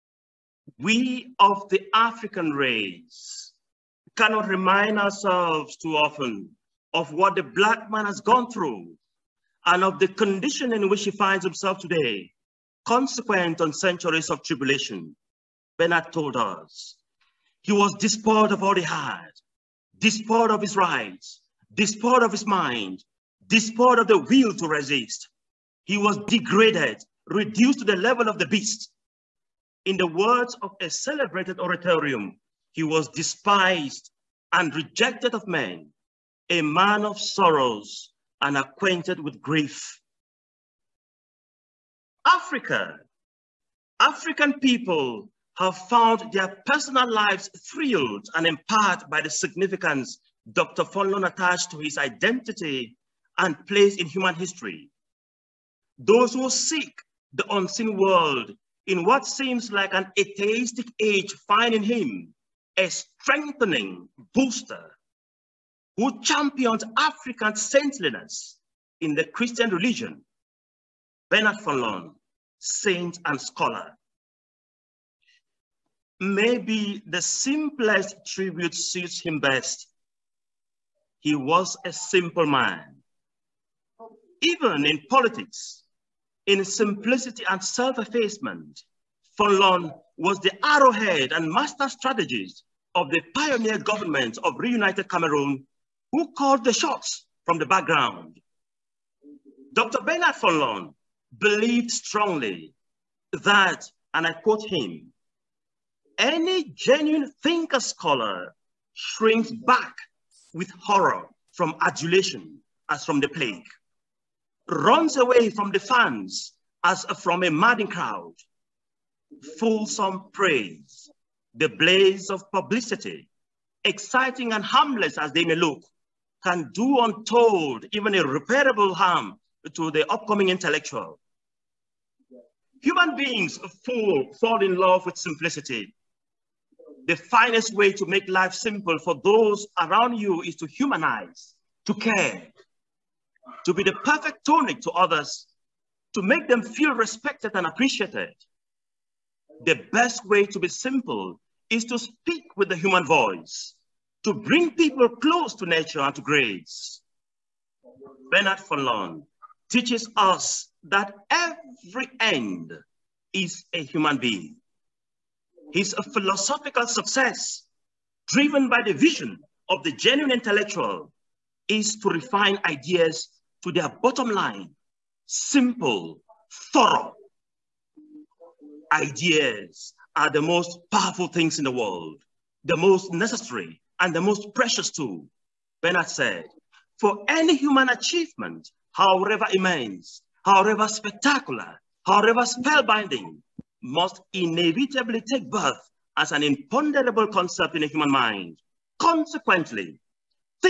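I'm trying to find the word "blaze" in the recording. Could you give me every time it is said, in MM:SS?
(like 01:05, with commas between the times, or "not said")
02:01.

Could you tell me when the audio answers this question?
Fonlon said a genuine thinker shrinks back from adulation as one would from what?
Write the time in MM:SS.
01:53.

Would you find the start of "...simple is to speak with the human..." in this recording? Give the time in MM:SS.
02:30.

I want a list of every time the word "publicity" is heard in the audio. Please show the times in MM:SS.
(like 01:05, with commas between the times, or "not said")
02:02.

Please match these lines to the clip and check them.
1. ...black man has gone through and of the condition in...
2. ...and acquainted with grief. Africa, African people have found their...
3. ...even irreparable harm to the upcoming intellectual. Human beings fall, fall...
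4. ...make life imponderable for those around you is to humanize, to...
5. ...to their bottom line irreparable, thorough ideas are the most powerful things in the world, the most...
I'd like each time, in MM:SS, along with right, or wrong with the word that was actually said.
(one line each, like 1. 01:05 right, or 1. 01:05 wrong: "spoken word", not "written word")
1. 00:07 right
2. 00:38 right
3. 02:07 right
4. 02:18 wrong: "simple", not "imponderable"
5. 02:53 wrong: "simple", not "irreparable".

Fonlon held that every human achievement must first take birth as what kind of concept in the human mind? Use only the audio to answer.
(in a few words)
an imponderable concept.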